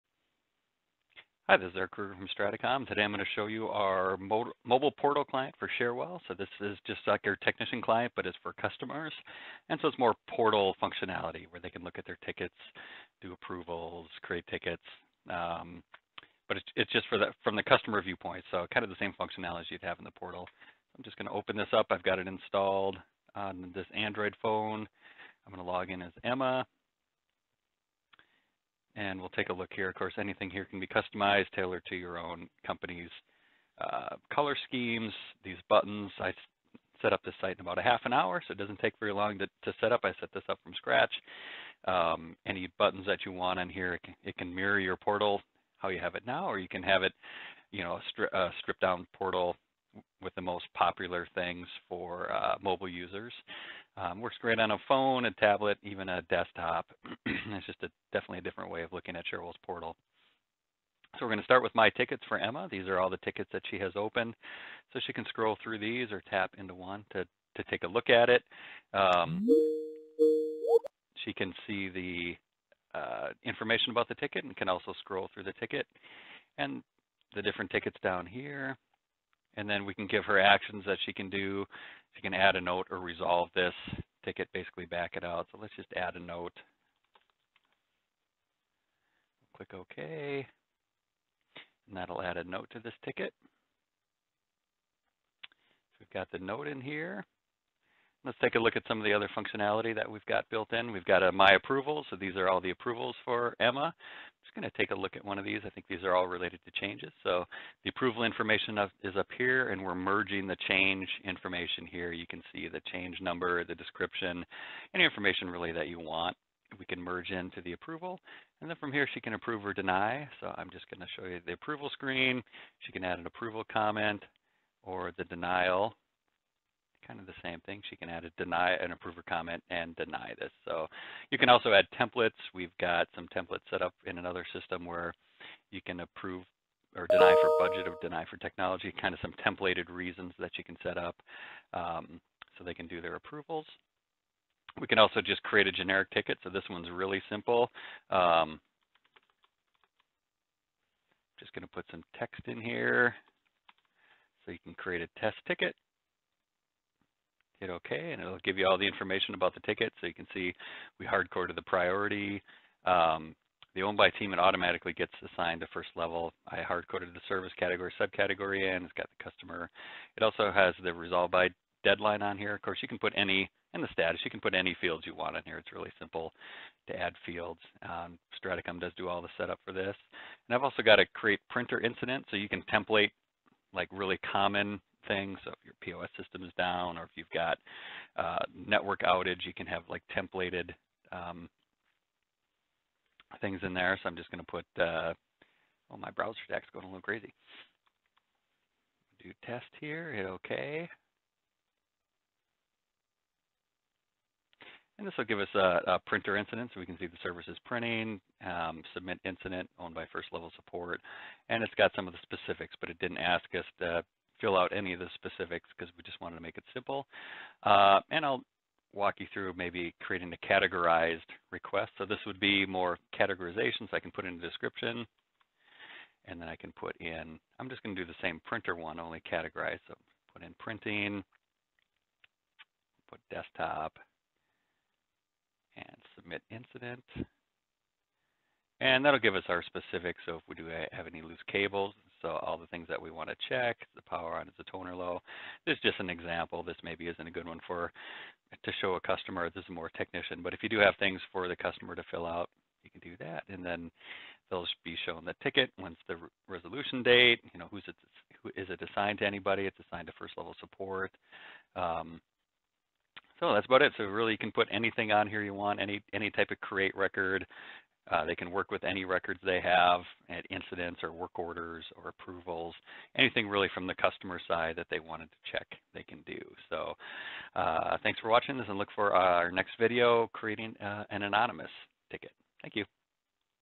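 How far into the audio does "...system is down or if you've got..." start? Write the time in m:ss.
3:06.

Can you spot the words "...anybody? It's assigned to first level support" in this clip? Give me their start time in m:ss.
4:19.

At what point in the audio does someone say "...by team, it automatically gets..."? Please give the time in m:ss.
2:43.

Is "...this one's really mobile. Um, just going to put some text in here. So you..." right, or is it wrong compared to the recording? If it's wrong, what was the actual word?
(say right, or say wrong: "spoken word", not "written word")
wrong: "simple", not "mobile".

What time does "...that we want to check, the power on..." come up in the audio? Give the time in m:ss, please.
4:02.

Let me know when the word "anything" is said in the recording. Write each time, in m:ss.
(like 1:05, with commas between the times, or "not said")
0:30, 4:24, 4:33.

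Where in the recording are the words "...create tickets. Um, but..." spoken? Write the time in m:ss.
0:14.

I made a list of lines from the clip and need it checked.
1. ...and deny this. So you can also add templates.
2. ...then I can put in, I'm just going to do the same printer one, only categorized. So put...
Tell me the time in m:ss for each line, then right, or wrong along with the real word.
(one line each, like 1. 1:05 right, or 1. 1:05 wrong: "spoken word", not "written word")
1. 2:09 right
2. 3:46 right.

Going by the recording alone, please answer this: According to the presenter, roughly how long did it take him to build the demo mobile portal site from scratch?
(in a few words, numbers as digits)
half an hour.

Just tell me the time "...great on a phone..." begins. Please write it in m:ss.
0:54.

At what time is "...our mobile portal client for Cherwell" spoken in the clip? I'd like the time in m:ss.
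0:03.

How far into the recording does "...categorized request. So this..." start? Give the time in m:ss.
3:40.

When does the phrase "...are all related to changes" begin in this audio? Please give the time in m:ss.
1:46.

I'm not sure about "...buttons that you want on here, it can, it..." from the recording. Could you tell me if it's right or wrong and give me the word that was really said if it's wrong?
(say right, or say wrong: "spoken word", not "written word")
right.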